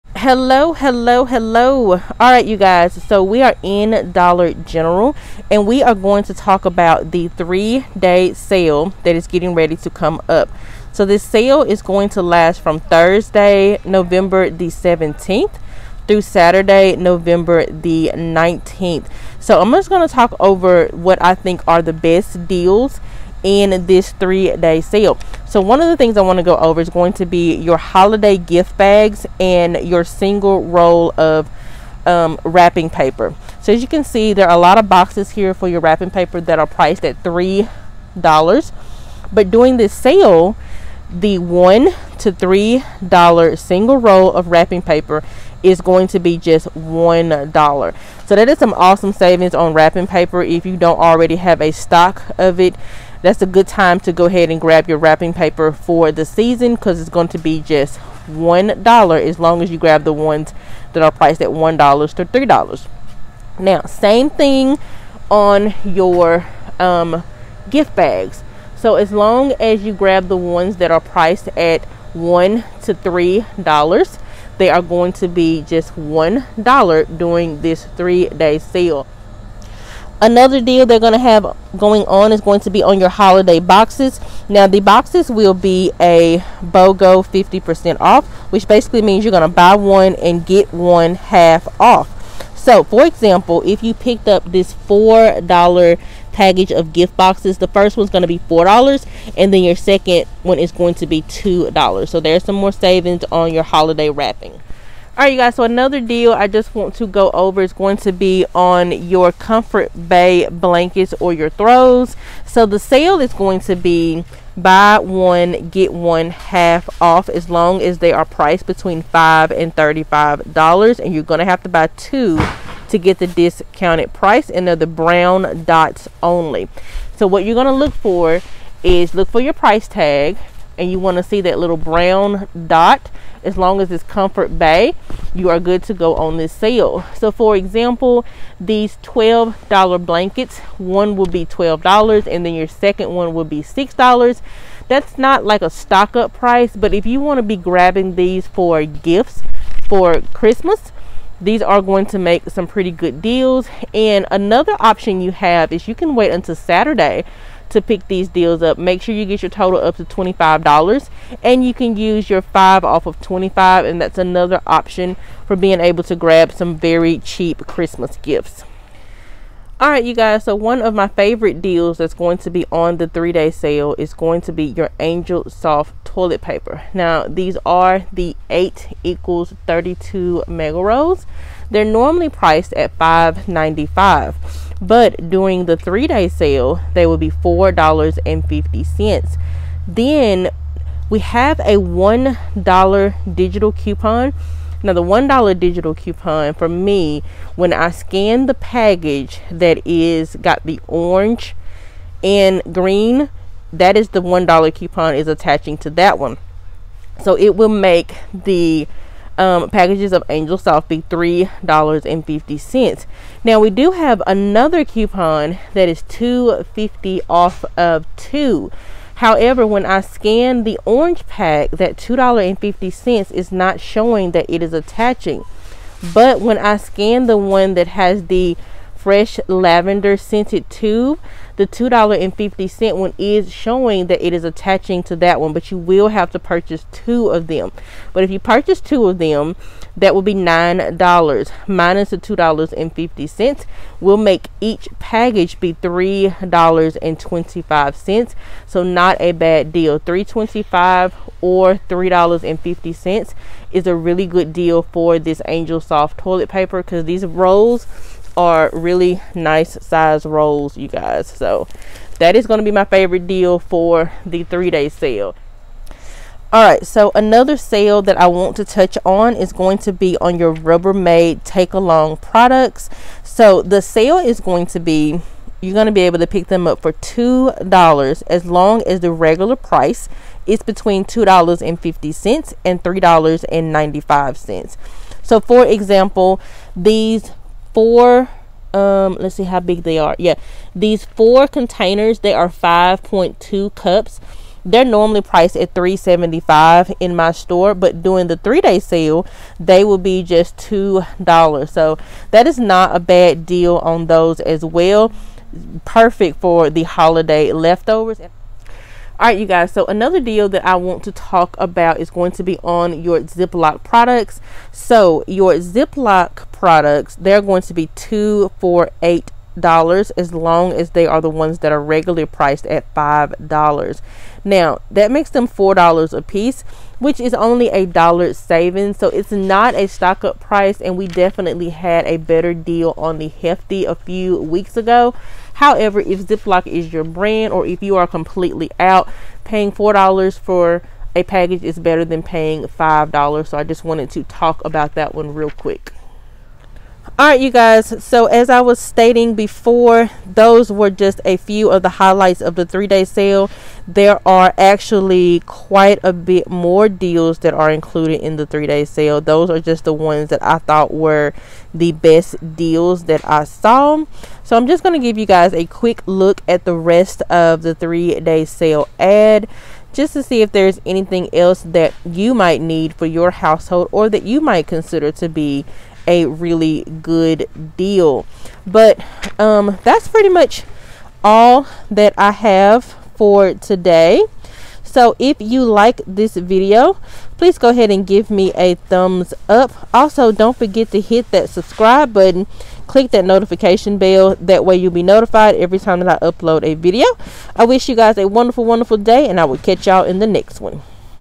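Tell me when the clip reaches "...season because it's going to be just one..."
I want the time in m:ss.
0:56.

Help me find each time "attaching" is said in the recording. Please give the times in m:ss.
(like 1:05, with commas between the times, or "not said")
3:25, 3:44, 3:54.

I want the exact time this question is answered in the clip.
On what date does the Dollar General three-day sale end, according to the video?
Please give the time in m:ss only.
0:16.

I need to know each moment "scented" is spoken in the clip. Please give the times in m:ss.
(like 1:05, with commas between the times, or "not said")
3:50.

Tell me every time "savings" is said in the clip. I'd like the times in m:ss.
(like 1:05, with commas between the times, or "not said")
0:49, 1:42, 5:28.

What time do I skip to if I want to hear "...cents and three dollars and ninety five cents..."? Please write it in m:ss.
4:42.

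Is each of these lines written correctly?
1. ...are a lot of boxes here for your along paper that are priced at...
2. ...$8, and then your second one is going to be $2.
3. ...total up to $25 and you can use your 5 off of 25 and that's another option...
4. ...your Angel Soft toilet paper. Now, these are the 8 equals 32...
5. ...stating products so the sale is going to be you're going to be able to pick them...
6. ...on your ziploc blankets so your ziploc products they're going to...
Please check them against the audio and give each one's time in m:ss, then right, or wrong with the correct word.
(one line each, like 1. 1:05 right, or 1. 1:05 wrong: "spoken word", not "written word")
1. 0:34 wrong: "wrapping", not "along"
2. 1:38 wrong: "4", not "8"
3. 2:39 right
4. 2:54 right
5. 4:31 wrong: "along", not "stating"
6. 5:12 wrong: "products", not "blankets".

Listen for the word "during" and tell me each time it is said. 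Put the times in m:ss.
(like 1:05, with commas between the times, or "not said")
0:39, 1:17, 3:05, 4:58.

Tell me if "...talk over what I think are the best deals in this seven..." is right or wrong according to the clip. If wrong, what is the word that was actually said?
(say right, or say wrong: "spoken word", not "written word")
wrong: "three", not "seven".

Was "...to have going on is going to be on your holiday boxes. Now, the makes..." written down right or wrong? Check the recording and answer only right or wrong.
wrong.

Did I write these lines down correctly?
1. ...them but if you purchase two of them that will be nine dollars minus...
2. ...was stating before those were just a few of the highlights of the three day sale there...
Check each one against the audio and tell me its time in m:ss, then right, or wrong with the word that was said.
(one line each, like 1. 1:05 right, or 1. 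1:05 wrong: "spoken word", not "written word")
1. 3:57 right
2. 5:48 right.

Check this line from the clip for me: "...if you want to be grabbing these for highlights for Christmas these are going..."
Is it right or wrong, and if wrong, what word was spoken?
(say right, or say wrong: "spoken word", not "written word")
wrong: "gifts", not "highlights".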